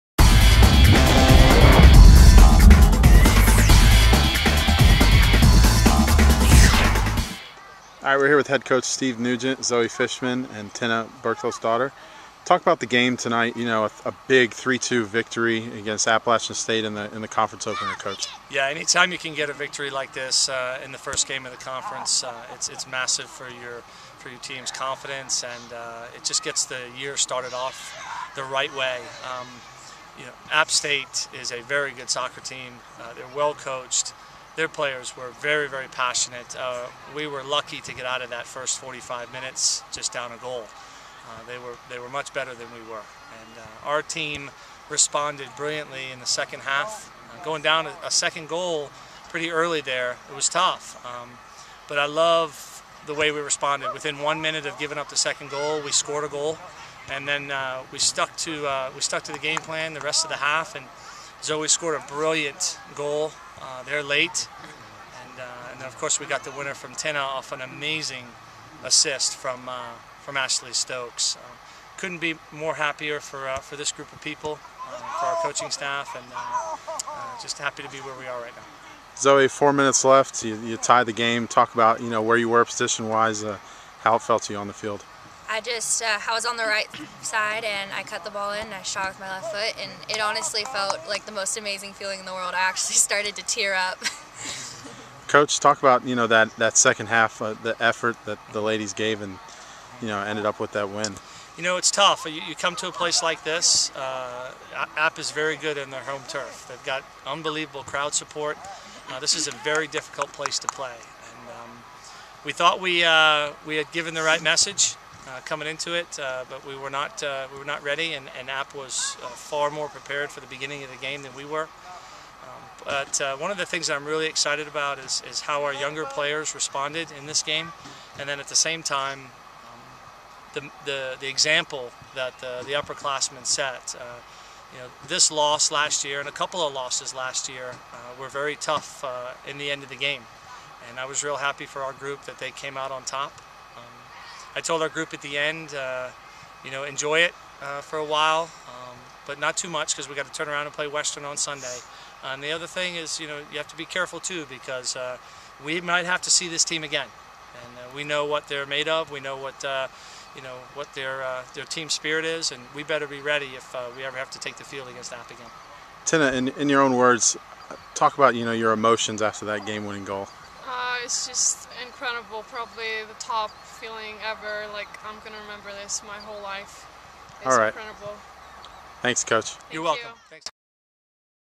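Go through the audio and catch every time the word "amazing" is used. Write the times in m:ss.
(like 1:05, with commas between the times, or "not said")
1:07, 1:31.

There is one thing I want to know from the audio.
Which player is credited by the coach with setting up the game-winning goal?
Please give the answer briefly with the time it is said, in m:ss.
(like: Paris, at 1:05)
Ashley Stokes, at 1:10.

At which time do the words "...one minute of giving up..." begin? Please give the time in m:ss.
0:54.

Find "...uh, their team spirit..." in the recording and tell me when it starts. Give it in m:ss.
2:41.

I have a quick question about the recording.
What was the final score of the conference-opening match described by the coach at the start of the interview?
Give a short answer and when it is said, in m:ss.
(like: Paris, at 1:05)
3-2, at 0:14.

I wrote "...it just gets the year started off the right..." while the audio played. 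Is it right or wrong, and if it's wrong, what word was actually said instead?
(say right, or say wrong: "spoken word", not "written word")
right.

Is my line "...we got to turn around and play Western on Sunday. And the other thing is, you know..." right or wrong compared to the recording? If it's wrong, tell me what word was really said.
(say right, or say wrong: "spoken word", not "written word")
right.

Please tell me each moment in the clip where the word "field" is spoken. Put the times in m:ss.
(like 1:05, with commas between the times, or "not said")
1:24, 2:44.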